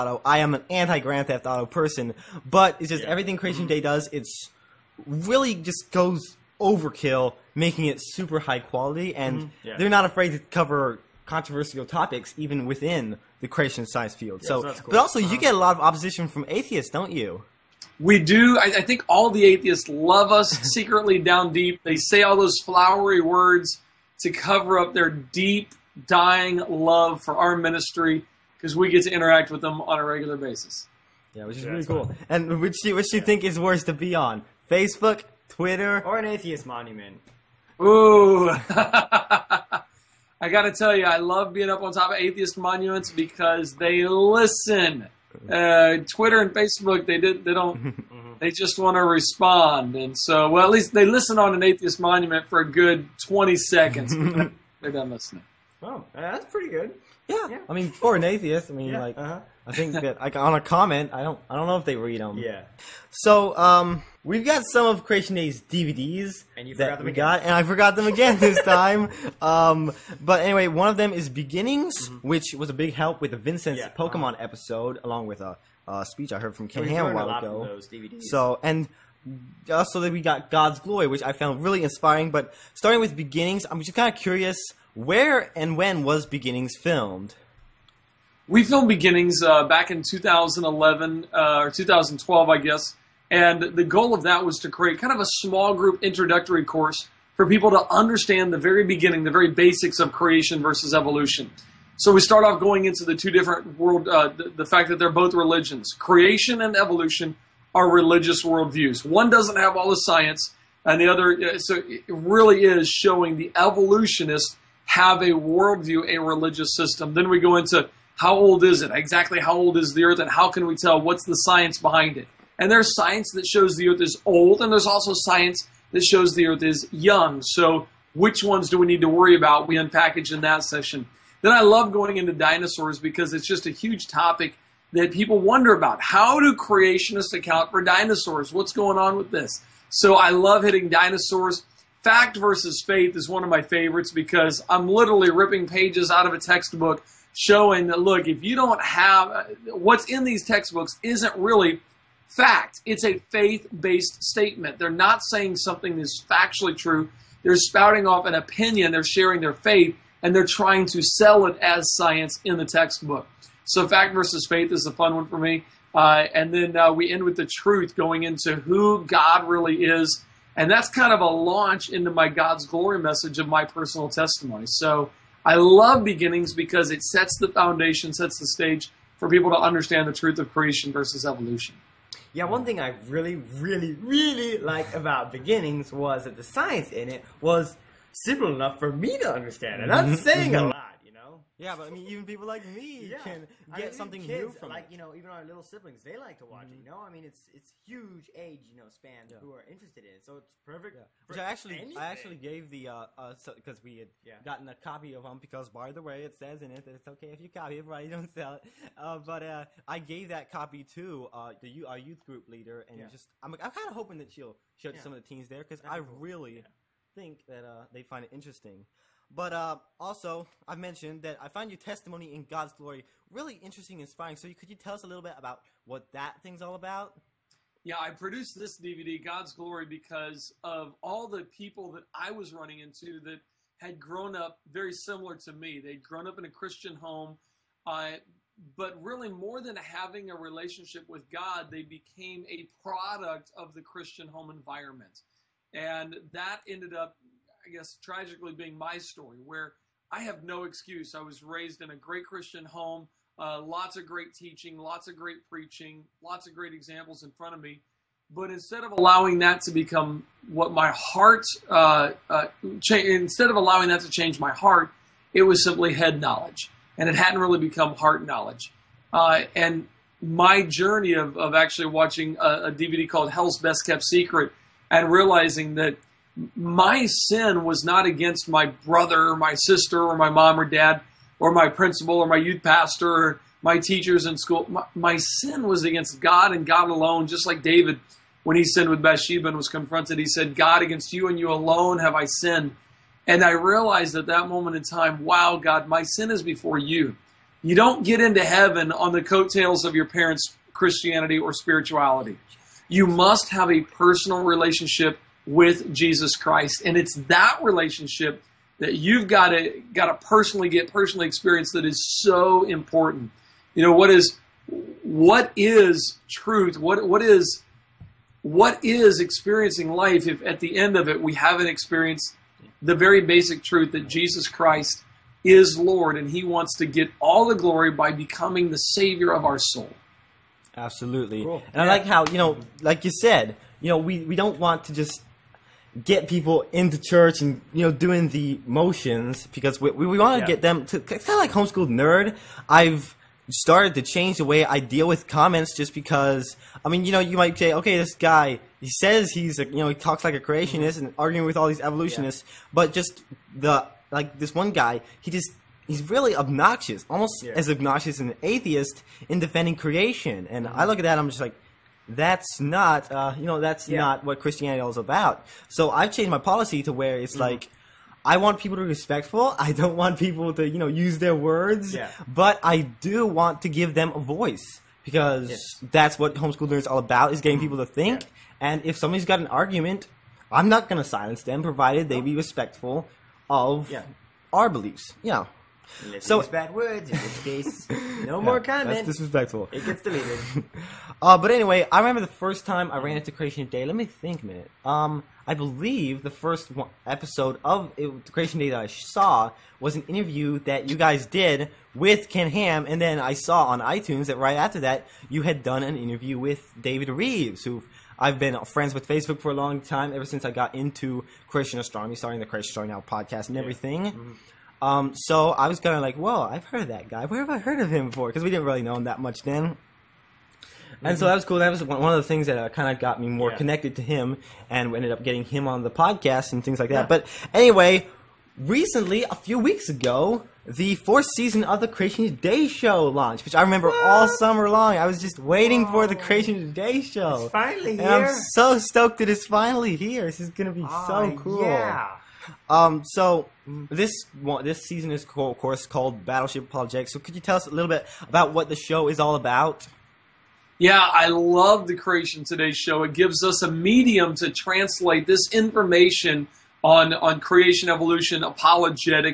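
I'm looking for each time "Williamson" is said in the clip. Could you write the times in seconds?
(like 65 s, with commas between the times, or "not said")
not said.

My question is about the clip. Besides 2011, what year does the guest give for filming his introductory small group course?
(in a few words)
2012.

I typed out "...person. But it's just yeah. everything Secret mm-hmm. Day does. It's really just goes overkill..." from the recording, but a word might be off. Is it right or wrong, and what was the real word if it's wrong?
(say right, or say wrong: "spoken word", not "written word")
wrong: "Creation", not "Secret".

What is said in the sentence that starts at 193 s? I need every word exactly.
can get I mean, something kids, new from like, it.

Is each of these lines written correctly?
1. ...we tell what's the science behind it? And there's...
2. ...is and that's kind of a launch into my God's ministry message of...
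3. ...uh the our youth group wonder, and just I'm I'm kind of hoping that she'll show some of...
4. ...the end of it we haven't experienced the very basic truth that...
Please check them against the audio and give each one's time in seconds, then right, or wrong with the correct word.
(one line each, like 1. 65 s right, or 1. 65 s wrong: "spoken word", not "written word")
1. 120 s right
2. 169 s wrong: "glory", not "ministry"
3. 211 s wrong: "leader", not "wonder"
4. 320 s right.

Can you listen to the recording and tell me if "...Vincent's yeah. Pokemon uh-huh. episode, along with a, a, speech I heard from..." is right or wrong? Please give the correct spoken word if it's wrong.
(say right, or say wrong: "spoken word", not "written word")
right.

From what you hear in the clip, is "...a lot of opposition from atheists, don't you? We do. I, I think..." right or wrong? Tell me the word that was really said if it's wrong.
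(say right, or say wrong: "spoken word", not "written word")
right.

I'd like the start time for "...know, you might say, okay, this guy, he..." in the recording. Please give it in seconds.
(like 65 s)
347 s.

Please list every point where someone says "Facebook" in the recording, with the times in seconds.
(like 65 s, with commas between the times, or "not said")
34 s, 46 s, 409 s.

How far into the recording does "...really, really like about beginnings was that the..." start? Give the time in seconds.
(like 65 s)
183 s.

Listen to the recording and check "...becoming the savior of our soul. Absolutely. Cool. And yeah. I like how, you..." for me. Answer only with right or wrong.
right.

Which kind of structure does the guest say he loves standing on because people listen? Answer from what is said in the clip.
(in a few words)
atheist monuments.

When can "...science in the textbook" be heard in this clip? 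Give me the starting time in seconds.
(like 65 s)
161 s.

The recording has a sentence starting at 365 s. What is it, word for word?
So I've changed my policy to where it's mm-hmm.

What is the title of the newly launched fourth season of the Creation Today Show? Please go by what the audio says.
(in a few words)
Battleship Apologetics.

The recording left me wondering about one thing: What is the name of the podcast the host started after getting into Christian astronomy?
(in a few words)
Creation Astronomy Now.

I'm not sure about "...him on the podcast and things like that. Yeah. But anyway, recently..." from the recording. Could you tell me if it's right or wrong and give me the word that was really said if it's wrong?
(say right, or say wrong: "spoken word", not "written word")
right.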